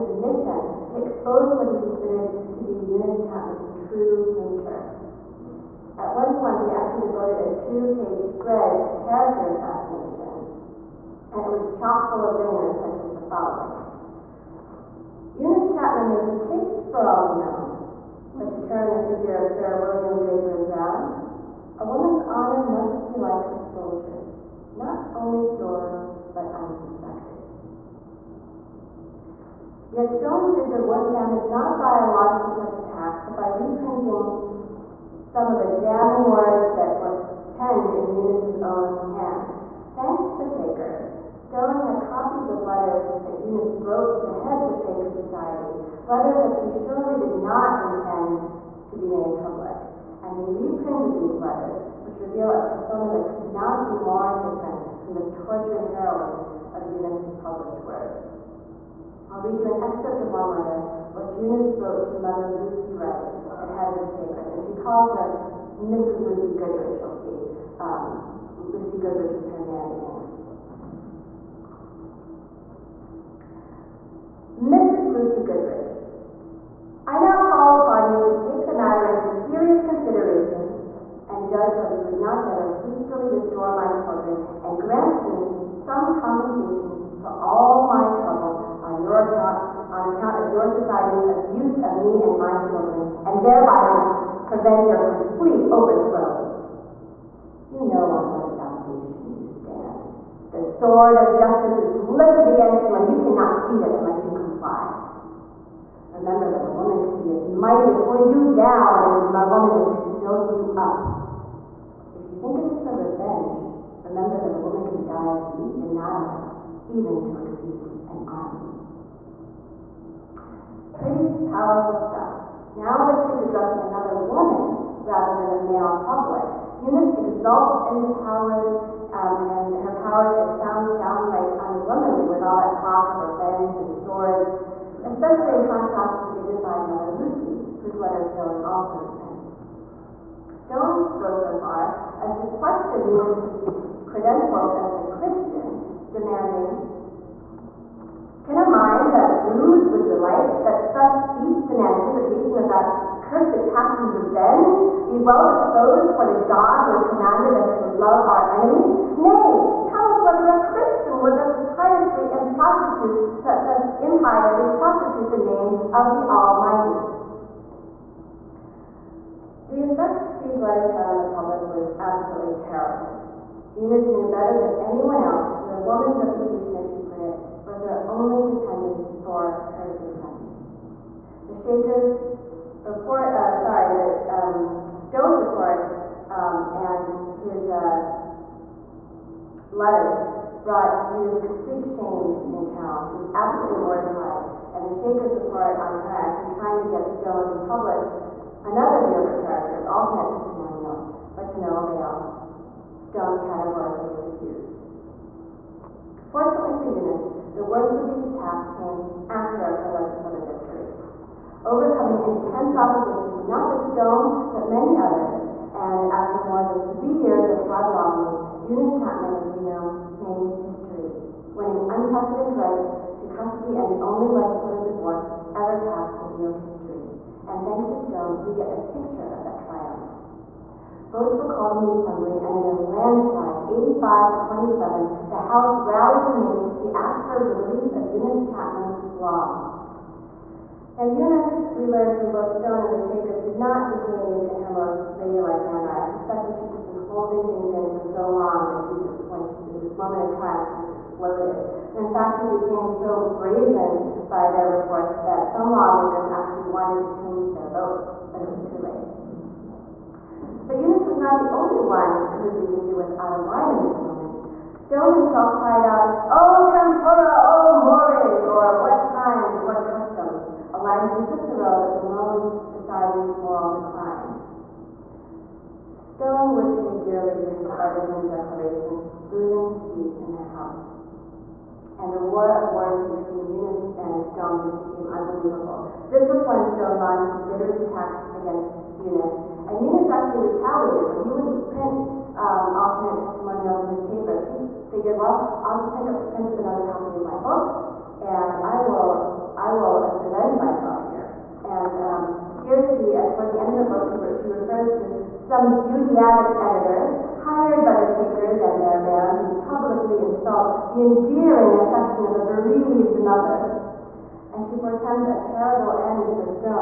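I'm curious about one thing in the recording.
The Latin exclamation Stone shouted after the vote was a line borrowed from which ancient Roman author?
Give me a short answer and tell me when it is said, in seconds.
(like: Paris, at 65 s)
Cicero, at 271 s.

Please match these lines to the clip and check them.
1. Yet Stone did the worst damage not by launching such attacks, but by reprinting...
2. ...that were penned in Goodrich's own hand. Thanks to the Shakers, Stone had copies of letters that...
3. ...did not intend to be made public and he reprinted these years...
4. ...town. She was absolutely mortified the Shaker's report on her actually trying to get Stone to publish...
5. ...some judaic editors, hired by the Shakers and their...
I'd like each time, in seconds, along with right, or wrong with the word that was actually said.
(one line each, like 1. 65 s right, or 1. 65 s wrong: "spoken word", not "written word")
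1. 29 s right
2. 36 s wrong: "Eunice", not "Goodrich"
3. 47 s wrong: "letters", not "years"
4. 192 s right
5. 305 s right.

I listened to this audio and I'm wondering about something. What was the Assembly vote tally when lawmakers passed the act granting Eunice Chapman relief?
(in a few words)
85 to 27.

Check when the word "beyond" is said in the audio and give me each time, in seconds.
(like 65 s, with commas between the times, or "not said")
not said.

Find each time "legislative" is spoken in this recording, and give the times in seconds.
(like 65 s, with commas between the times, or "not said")
209 s, 224 s.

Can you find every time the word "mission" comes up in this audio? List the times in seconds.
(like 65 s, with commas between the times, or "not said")
0 s.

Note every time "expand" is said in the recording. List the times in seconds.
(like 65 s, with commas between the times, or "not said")
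not said.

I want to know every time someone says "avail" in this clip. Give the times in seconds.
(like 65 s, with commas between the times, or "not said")
201 s.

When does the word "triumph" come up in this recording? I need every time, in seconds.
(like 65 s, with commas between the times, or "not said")
229 s, 250 s.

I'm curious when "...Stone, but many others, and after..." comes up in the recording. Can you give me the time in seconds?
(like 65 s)
213 s.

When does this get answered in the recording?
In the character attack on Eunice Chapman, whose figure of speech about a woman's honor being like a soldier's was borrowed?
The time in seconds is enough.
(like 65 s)
19 s.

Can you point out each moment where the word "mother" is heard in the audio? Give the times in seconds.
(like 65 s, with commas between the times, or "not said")
62 s, 313 s.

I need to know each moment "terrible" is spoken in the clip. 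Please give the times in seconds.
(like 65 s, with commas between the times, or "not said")
172 s, 315 s.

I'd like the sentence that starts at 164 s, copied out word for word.
prostitute the name of the Almighty.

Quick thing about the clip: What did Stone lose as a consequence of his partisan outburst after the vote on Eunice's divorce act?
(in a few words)
His seat in the House.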